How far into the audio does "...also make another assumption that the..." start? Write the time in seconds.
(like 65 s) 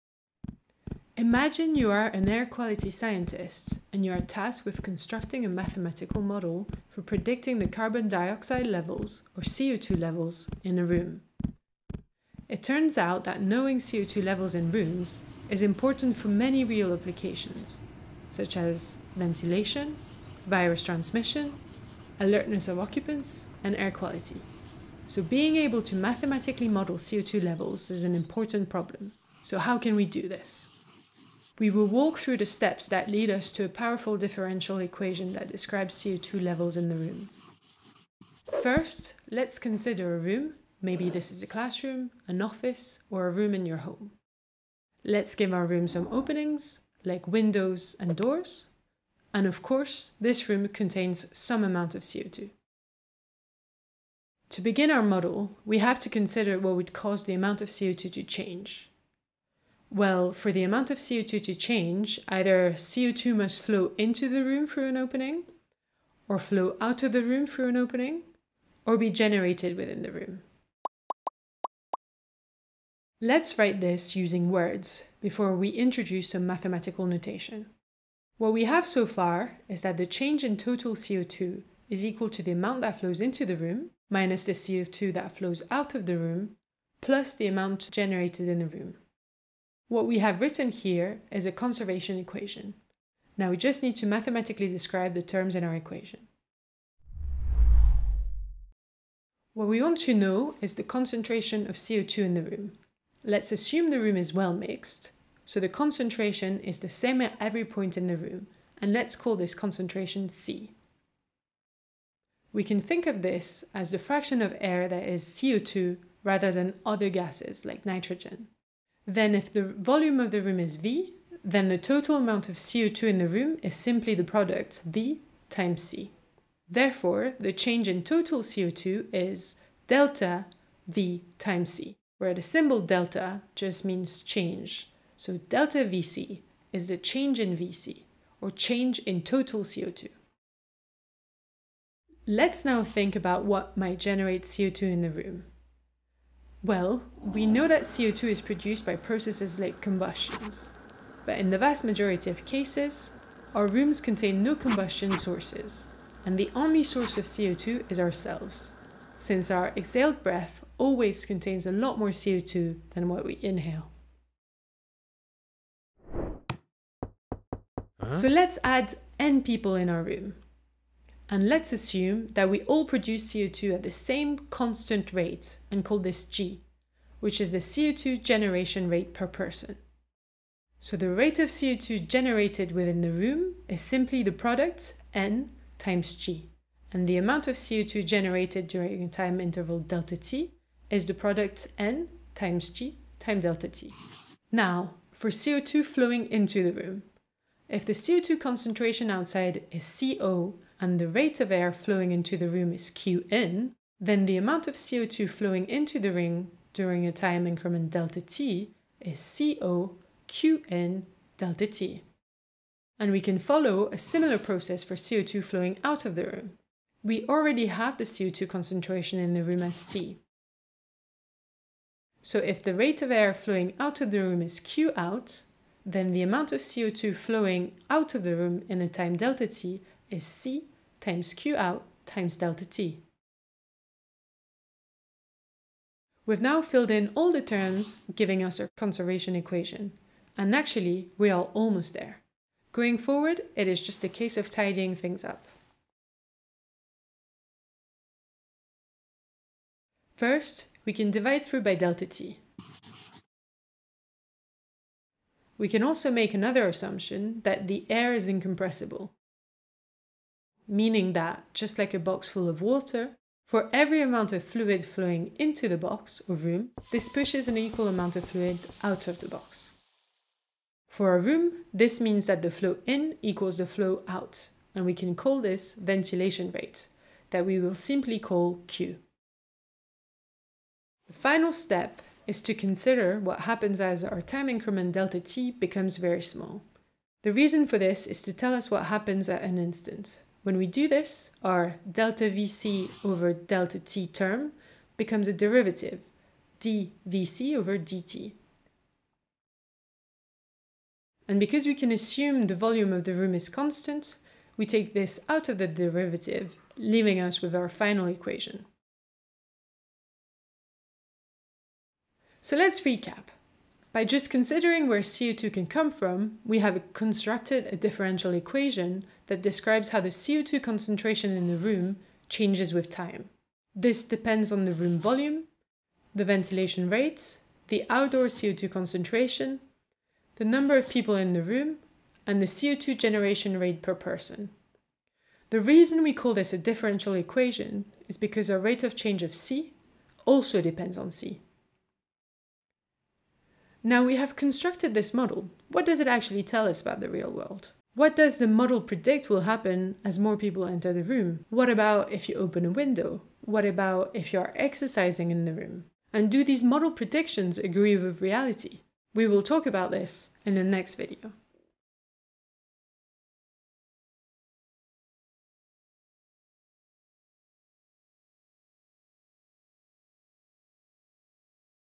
255 s.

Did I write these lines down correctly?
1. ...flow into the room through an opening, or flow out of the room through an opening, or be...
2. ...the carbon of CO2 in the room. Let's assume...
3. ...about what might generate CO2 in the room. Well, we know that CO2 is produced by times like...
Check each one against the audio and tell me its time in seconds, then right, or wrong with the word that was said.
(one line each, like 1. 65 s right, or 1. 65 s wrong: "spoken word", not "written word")
1. 63 s right
2. 100 s wrong: "concentration", not "carbon"
3. 143 s wrong: "processes", not "times".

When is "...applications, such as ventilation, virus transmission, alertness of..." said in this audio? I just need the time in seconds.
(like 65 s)
16 s.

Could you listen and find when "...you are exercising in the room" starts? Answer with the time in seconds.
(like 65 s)
354 s.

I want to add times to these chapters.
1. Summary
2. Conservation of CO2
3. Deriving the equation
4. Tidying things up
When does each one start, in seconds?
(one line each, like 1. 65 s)
1. 311 s
2. 38 s
3. 96 s
4. 248 s.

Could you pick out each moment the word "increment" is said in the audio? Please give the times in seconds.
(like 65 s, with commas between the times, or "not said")
207 s, 284 s.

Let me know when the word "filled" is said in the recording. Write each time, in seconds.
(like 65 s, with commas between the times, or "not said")
236 s.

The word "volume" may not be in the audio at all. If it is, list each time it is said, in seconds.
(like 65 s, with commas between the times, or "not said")
119 s, 302 s, 324 s.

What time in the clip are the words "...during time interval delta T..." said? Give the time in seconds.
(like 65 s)
188 s.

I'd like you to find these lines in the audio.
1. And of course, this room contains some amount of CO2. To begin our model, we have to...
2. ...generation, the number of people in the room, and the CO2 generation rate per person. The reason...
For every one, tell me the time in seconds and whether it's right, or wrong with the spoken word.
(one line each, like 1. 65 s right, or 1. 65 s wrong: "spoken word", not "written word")
1. 49 s right
2. 328 s wrong: "concentration", not "generation".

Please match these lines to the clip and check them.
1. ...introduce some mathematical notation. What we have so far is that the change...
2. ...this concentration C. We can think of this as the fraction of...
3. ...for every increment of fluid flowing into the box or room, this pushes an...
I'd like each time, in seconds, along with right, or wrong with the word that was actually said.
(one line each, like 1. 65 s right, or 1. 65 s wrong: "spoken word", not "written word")
1. 75 s right
2. 109 s right
3. 263 s wrong: "amount", not "increment".